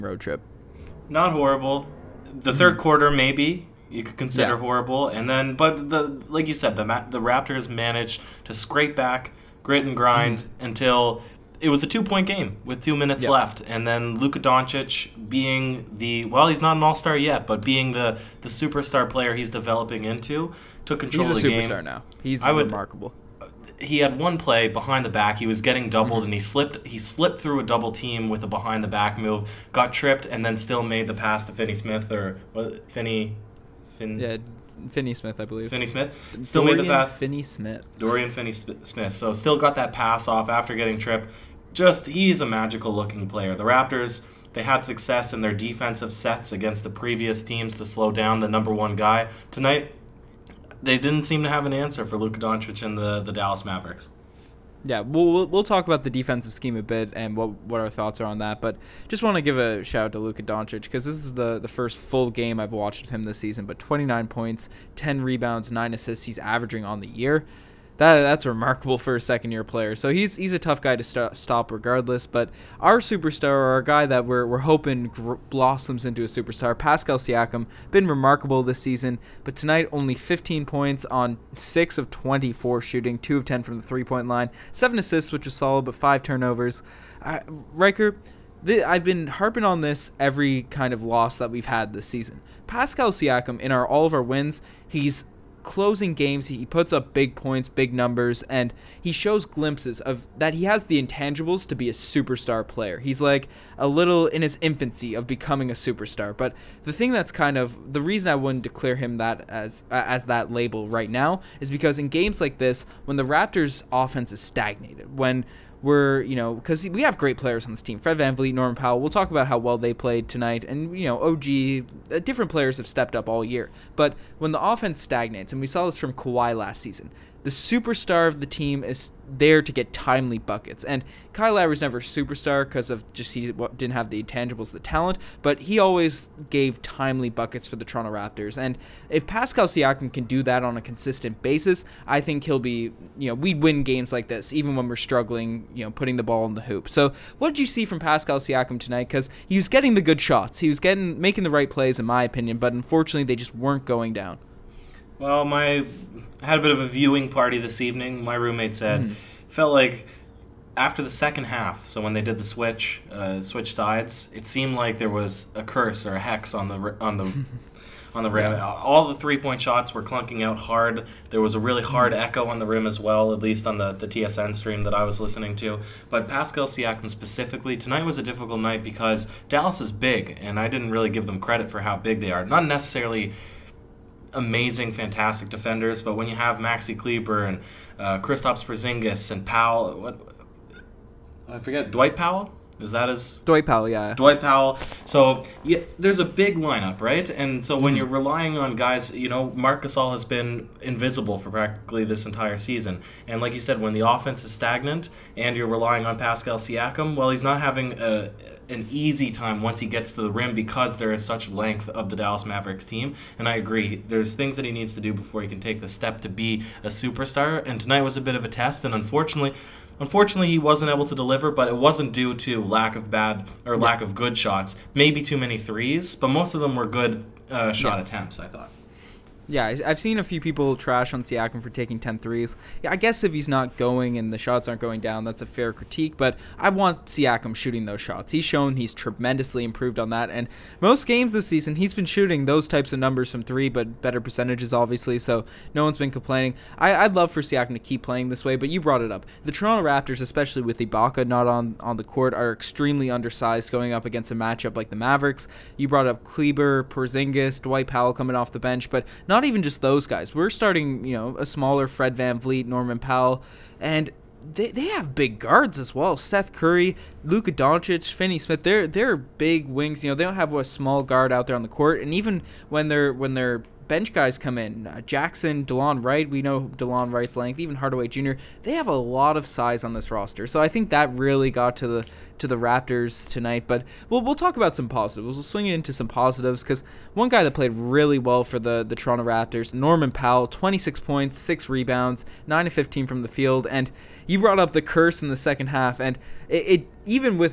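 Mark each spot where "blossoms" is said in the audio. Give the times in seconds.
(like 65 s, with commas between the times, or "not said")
75 s.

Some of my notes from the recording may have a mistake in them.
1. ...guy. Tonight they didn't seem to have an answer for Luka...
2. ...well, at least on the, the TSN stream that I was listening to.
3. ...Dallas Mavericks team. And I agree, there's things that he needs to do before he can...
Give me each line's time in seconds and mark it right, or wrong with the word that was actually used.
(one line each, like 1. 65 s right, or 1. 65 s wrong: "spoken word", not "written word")
1. 48 s right
2. 172 s right
3. 212 s right.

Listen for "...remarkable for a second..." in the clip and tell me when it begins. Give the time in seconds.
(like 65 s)
68 s.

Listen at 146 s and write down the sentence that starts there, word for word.
So, what did you see from Pascal Siakam tonight cuz he was getting the good shots.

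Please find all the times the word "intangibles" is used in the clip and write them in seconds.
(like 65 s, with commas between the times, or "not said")
101 s, 134 s.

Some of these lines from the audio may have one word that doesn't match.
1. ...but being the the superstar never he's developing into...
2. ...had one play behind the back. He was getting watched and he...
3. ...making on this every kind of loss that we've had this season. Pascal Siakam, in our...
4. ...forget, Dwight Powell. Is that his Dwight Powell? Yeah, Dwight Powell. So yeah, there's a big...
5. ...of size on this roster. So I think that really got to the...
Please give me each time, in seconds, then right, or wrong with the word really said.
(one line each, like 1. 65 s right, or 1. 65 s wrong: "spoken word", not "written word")
1. 17 s wrong: "player", not "never"
2. 23 s wrong: "doubled", not "watched"
3. 89 s wrong: "harping", not "making"
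4. 191 s right
5. 279 s right.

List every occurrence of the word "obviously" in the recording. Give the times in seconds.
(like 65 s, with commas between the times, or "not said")
244 s.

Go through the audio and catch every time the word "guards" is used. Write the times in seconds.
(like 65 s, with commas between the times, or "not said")
265 s, 271 s.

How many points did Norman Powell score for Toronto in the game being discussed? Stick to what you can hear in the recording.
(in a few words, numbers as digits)
26.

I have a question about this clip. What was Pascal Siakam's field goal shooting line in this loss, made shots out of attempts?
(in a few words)
6 of 24.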